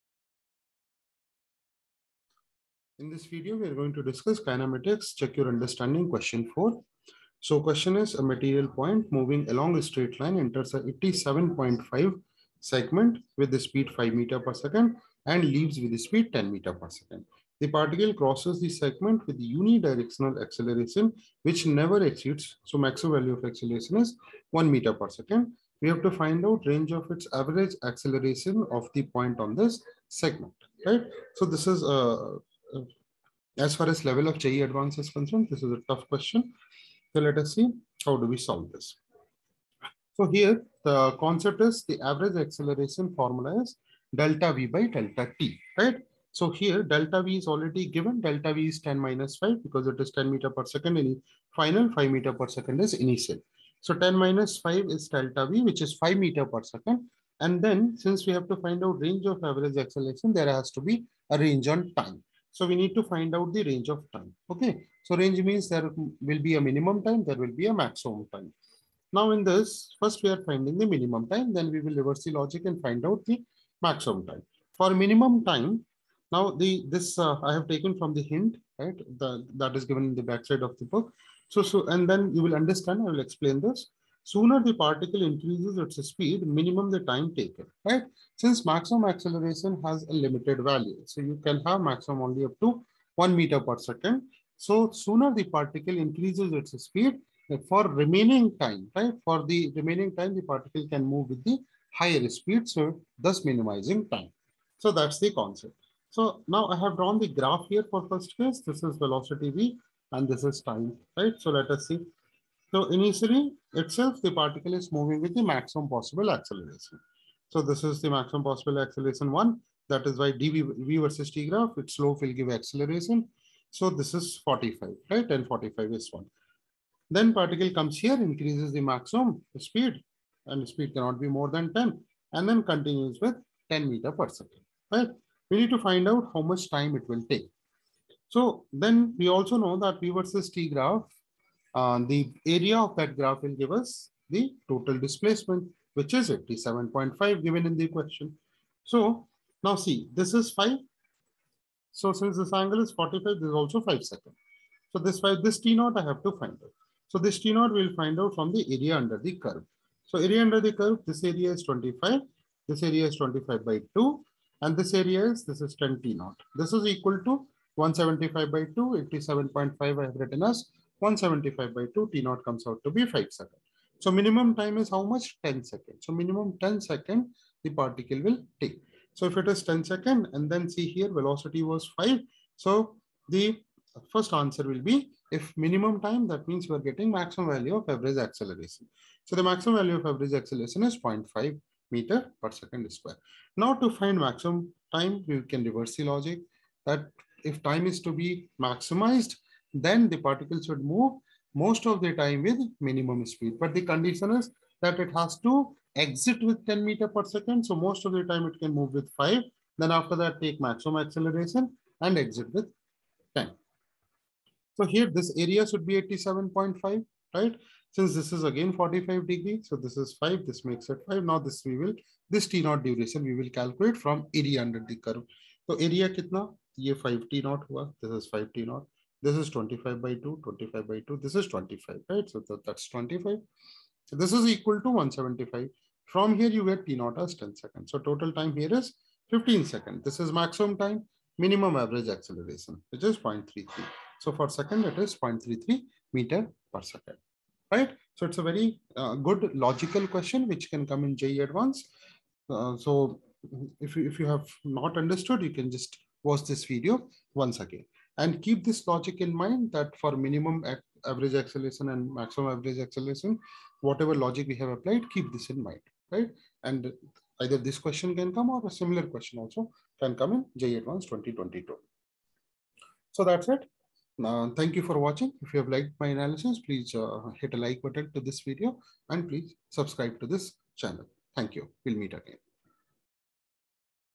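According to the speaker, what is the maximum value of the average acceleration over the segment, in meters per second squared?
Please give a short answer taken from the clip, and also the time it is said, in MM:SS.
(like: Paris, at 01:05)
0.5, at 03:10.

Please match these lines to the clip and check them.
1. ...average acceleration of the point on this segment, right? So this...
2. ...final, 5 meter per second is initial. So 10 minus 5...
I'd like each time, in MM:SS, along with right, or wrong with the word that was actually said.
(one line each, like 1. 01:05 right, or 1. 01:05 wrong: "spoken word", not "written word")
1. 00:27 right
2. 00:51 right.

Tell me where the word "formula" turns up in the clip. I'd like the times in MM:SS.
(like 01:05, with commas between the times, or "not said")
00:43.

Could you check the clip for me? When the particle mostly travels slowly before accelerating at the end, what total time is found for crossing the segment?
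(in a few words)
15 seconds.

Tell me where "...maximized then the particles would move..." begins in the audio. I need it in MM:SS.
03:18.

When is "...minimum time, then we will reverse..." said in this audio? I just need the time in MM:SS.
01:10.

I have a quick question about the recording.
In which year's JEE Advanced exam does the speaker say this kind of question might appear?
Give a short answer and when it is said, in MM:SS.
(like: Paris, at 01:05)
2022, at 04:31.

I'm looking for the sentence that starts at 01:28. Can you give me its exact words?
Since maximum acceleration has a limited value.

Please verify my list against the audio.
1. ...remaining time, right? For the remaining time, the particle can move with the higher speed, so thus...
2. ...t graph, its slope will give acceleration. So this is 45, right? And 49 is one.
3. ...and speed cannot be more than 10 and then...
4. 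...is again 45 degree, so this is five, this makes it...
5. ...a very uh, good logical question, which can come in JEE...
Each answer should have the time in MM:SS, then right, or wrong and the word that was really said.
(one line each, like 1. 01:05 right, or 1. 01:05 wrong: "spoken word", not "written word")
1. 01:37 right
2. 02:01 wrong: "45", not "49"
3. 02:10 right
4. 03:38 right
5. 04:08 right.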